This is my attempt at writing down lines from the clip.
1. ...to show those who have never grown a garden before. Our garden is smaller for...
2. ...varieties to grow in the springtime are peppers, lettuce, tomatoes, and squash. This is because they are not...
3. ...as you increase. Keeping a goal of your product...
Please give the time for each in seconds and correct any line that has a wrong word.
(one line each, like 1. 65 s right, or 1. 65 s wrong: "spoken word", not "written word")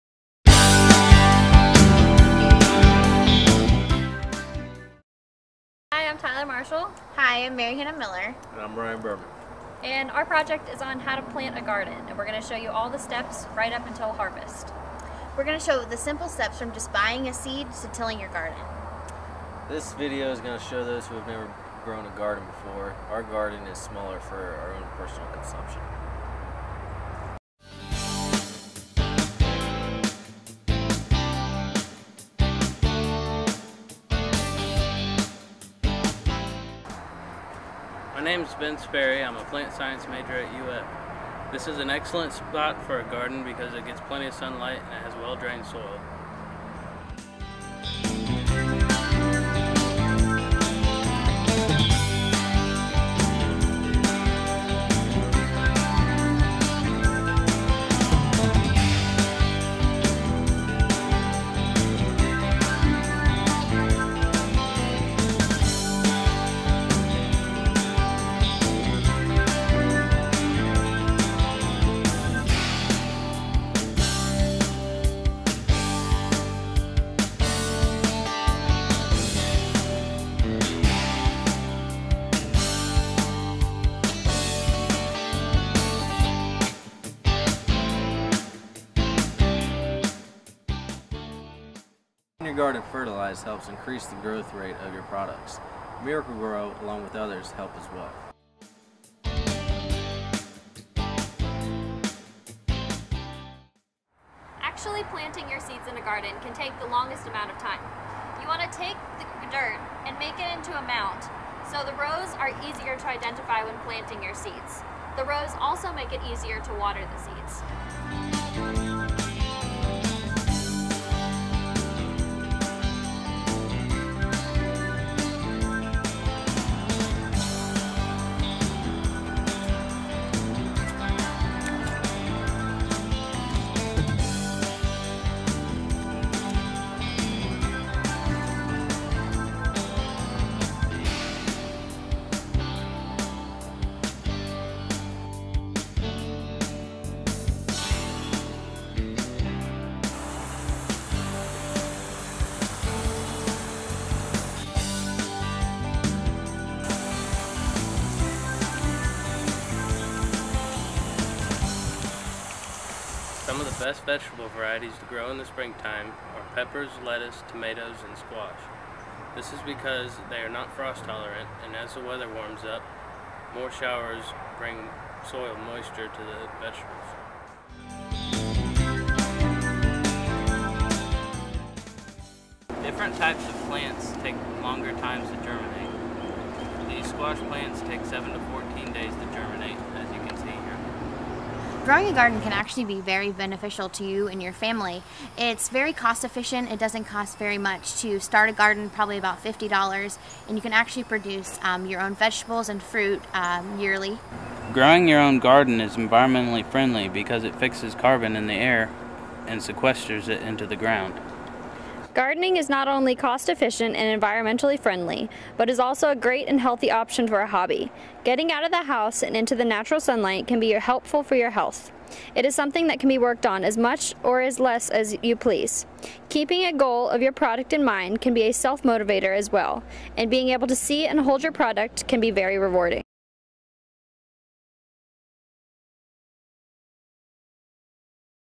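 1. 20 s right
2. 164 s right
3. 224 s wrong: "please", not "increase".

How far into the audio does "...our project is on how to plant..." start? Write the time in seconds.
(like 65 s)
10 s.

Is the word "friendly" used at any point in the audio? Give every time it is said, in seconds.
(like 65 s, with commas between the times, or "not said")
206 s, 214 s.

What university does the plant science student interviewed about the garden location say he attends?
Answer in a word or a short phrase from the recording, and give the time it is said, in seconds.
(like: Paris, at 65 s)
UF, at 40 s.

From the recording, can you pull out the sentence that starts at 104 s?
Actually planting your seeds in a garden can take the longest amount of time.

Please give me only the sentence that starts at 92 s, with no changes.
your garden fertilized helps increase the growth rate of your products.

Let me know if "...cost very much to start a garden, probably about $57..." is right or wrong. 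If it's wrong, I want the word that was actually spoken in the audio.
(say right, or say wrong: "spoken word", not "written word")
wrong: "50", not "57".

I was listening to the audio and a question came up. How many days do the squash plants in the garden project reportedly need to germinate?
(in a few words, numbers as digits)
7 to 14 days.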